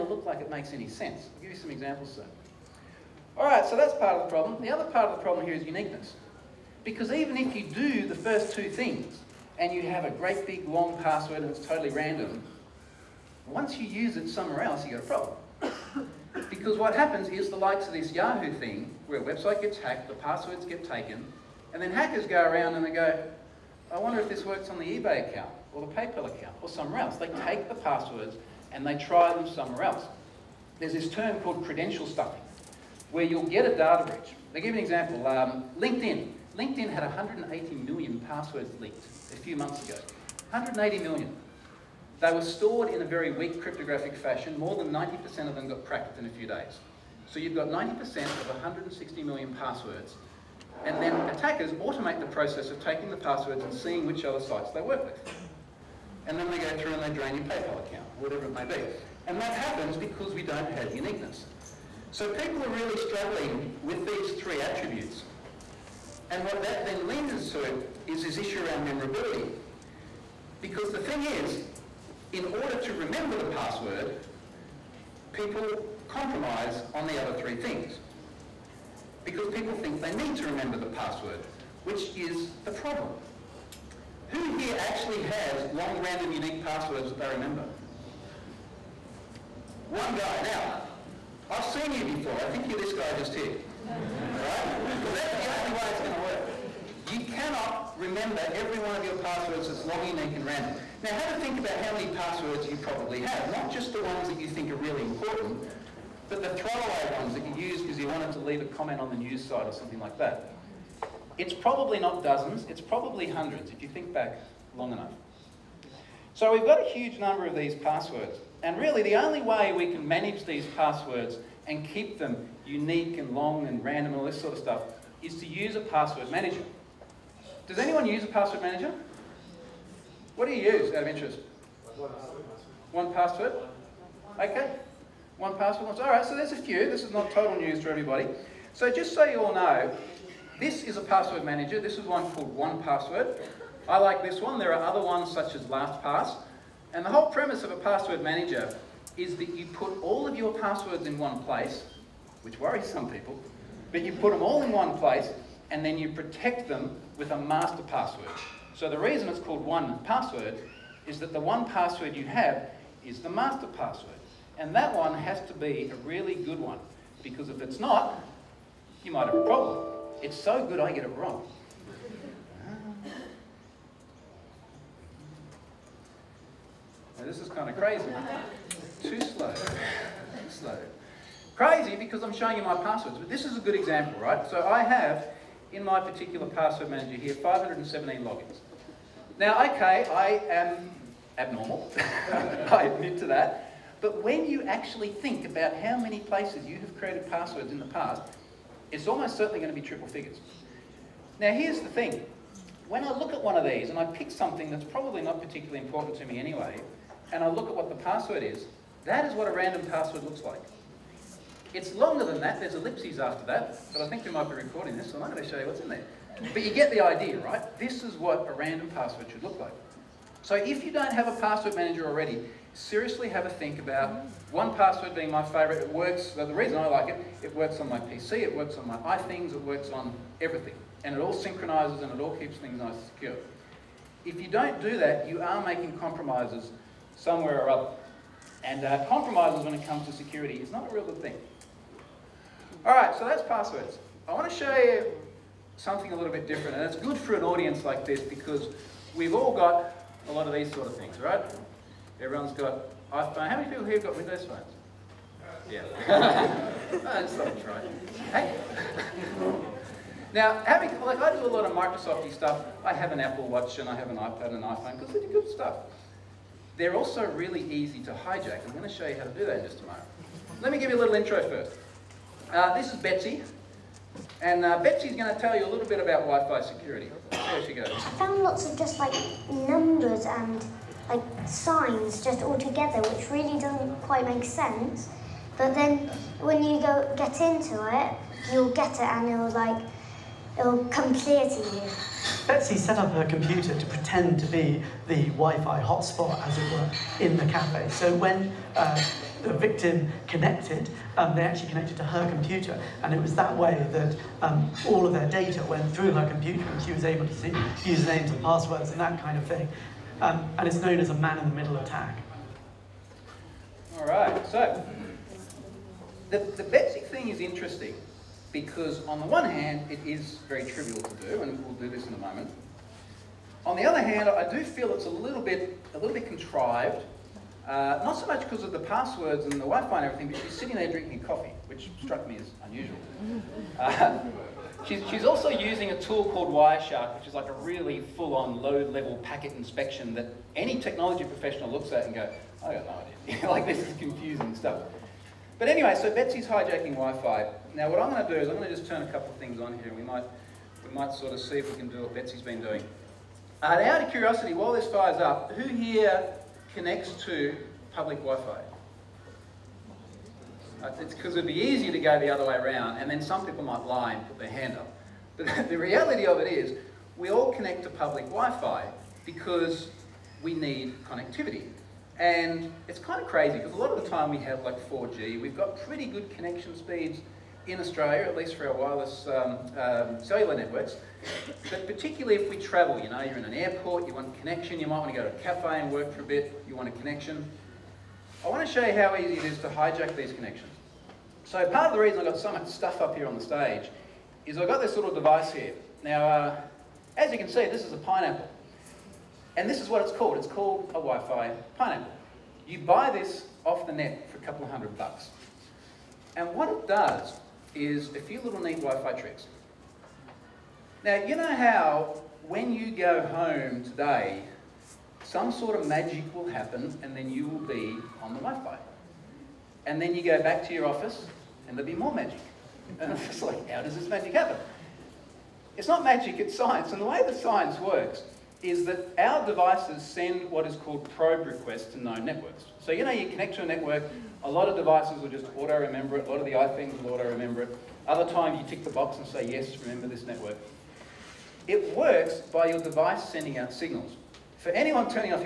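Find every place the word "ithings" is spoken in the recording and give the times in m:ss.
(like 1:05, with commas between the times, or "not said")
3:48, 7:16.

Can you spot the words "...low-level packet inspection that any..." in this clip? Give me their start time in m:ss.
5:38.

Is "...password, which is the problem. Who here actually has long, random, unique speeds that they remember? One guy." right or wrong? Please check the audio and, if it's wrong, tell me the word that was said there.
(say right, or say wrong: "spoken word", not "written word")
wrong: "passwords", not "speeds".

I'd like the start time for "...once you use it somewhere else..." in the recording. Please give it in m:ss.
0:13.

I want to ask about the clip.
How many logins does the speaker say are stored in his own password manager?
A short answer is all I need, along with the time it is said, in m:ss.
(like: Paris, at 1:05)
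517, at 3:07.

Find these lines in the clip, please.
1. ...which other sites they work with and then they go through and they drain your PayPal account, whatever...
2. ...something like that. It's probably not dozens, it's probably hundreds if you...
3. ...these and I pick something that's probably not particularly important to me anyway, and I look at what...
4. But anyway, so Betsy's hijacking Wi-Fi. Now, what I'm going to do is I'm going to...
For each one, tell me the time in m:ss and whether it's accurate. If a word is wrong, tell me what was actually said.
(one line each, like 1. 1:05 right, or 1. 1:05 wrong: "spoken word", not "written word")
1. 0:54 right
2. 1:49 right
3. 3:23 right
4. 5:45 right.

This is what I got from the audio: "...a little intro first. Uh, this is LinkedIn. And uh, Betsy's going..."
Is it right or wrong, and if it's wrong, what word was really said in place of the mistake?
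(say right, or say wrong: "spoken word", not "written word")
wrong: "Betsy", not "LinkedIn".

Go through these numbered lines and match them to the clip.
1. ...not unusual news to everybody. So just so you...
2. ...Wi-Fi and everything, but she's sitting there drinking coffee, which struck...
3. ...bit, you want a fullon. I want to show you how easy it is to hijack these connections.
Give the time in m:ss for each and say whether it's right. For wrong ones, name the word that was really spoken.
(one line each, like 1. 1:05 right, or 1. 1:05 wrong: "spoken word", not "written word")
1. 2:17 wrong: "total", not "unusual"
2. 5:29 right
3. 6:26 wrong: "connection", not "fullon".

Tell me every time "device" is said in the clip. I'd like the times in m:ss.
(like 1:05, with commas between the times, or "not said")
6:35, 7:09, 7:14, 7:22.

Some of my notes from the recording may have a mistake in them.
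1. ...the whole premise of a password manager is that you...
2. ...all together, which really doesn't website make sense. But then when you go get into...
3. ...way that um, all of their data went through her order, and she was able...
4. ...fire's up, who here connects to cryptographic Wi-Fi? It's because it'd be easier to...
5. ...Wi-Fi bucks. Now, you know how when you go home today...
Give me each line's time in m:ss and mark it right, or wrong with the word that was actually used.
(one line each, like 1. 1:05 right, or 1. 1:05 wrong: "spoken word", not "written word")
1. 2:27 right
2. 4:42 wrong: "quite", not "website"
3. 5:03 wrong: "computer", not "order"
4. 5:54 wrong: "public", not "cryptographic"
5. 6:48 wrong: "tricks", not "bucks".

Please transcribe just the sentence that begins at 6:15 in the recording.
We've got pretty good connection speeds in Australia, at least for our wireless um, um, cellular networks.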